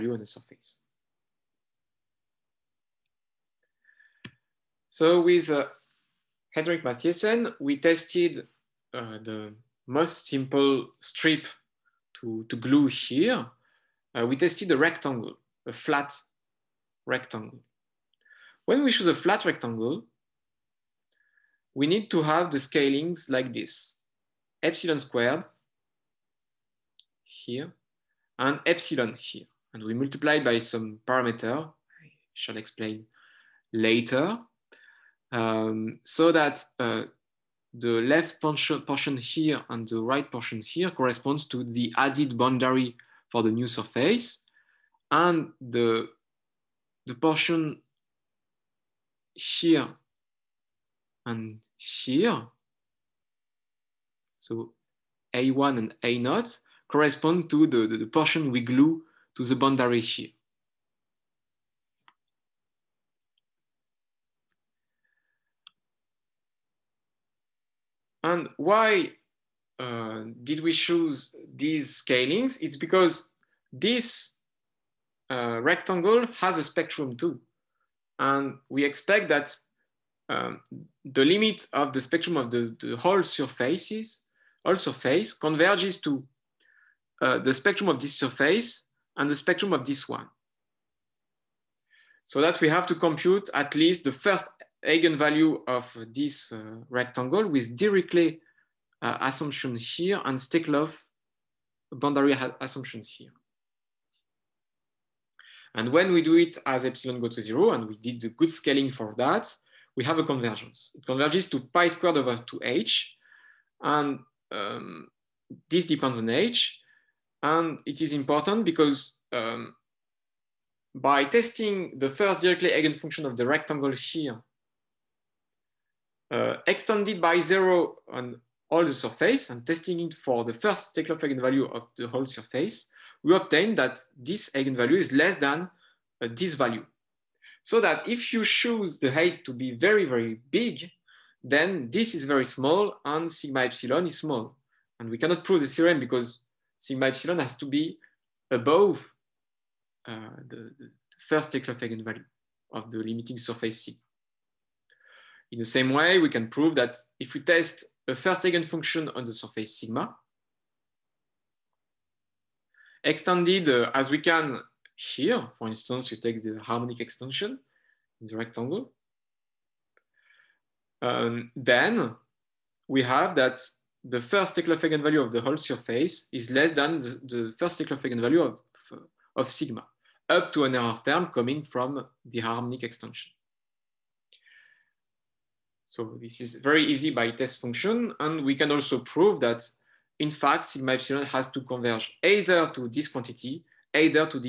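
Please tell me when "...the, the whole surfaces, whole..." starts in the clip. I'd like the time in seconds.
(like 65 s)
82 s.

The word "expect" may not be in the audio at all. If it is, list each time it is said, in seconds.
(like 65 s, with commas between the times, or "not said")
78 s.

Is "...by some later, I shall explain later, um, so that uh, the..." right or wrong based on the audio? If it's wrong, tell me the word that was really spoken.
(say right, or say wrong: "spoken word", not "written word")
wrong: "parameter", not "later".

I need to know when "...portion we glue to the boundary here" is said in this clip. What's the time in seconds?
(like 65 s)
58 s.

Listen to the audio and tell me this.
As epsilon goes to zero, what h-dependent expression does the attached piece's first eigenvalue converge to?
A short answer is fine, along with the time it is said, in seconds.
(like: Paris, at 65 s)
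pi squared over 2h, at 111 s.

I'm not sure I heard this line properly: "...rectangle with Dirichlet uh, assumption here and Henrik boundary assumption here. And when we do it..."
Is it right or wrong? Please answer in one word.
wrong.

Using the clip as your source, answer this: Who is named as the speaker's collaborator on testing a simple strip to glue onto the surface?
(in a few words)
Henrik Matthiesen.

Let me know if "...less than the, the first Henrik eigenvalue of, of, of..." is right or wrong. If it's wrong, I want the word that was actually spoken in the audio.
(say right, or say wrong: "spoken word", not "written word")
wrong: "Steklov", not "Henrik".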